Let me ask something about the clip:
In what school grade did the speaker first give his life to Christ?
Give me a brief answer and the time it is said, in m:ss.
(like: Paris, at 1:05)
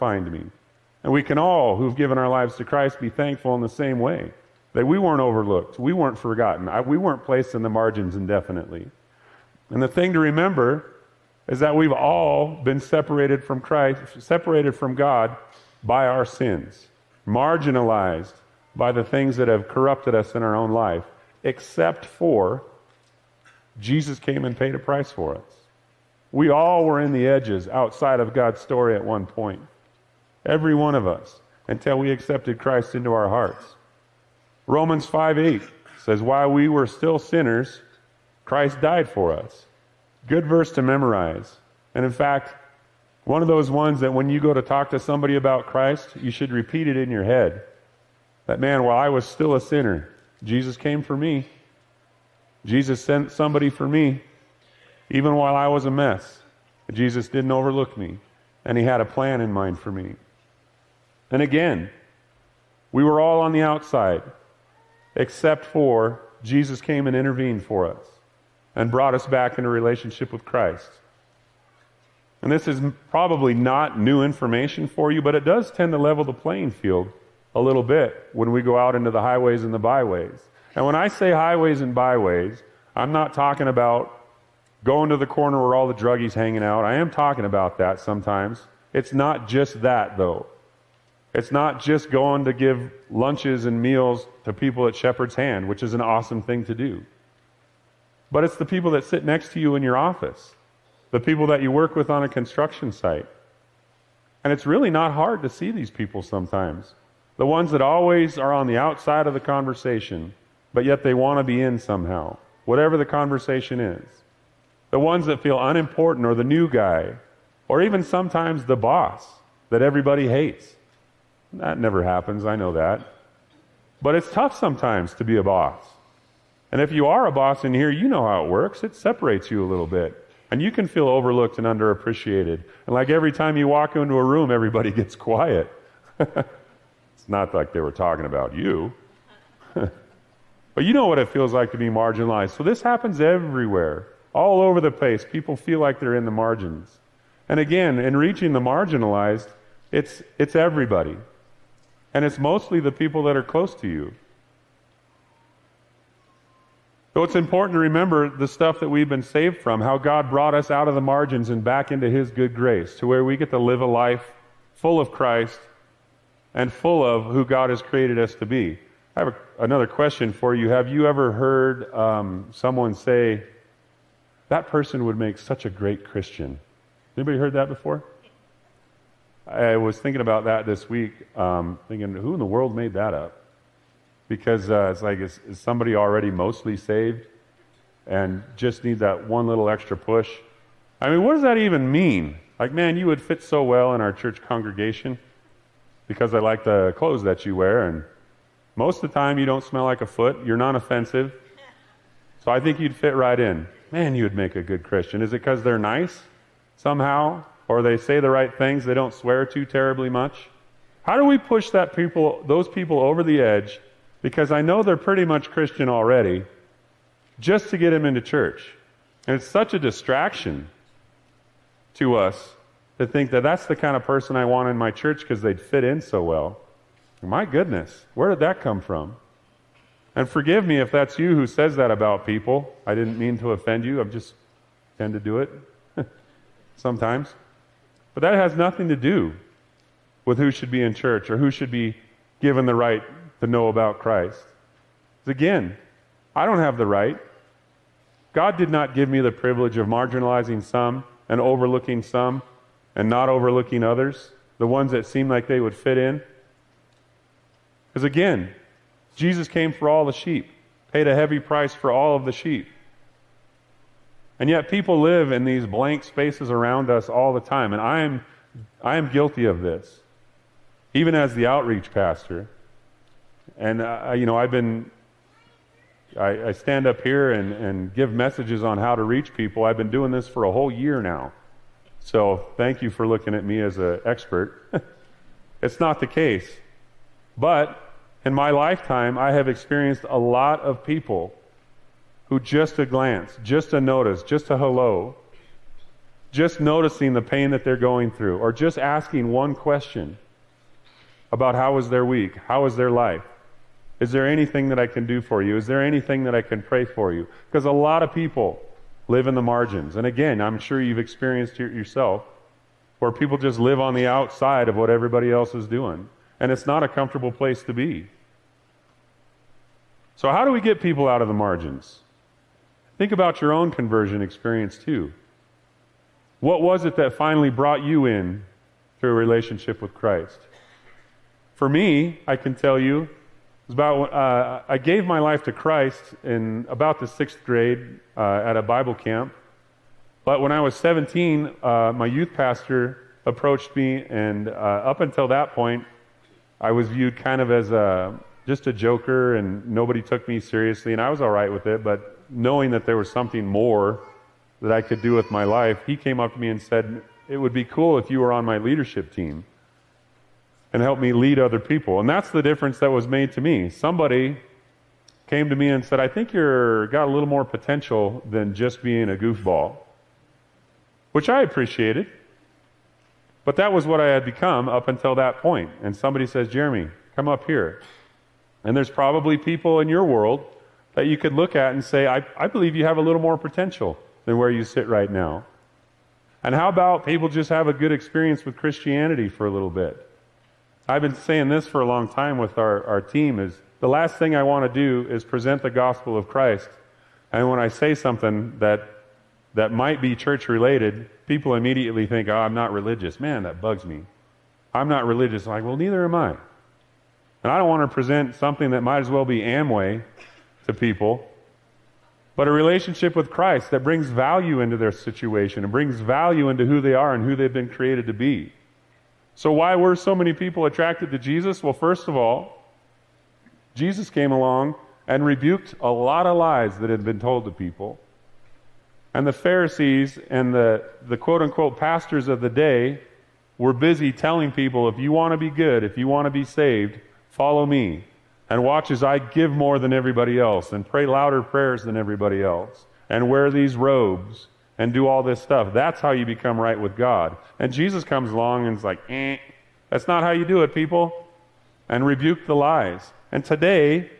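sixth grade, at 5:37.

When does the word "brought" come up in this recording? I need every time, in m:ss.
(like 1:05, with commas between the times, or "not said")
1:08, 2:40, 5:27.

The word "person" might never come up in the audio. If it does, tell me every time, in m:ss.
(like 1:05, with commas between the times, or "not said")
2:54, 3:44.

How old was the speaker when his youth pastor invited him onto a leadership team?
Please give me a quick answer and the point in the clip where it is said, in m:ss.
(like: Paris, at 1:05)
17, at 5:40.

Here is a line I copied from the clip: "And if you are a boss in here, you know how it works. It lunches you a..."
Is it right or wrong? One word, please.
wrong.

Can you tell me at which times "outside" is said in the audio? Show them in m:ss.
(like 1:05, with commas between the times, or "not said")
0:27, 1:03, 1:48, 5:14.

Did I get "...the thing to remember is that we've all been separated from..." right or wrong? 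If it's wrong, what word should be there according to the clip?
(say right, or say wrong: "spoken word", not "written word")
right.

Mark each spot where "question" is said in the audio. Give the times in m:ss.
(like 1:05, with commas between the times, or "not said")
2:49, 4:59.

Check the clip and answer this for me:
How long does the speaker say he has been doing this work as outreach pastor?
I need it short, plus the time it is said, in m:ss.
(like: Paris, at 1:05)
a whole year, at 4:40.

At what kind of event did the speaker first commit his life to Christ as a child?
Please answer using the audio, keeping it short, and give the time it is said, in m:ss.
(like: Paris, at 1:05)
a Bible camp, at 5:38.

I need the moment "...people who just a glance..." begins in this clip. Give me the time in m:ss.
4:50.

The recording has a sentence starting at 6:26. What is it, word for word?
And how about people just have a good experience with Christianity for a little bit?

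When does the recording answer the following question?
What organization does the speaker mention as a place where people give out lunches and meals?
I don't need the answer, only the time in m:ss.
1:34.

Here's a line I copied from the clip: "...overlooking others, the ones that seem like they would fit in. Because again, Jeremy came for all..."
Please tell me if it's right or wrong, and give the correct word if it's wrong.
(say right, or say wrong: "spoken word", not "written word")
wrong: "Jesus", not "Jeremy".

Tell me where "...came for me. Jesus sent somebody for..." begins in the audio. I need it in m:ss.
0:50.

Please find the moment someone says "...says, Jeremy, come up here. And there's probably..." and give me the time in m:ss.
6:16.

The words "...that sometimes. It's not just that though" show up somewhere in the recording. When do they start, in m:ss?
1:27.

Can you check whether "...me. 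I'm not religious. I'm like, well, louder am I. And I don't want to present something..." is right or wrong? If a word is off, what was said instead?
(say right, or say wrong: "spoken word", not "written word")
wrong: "neither", not "louder".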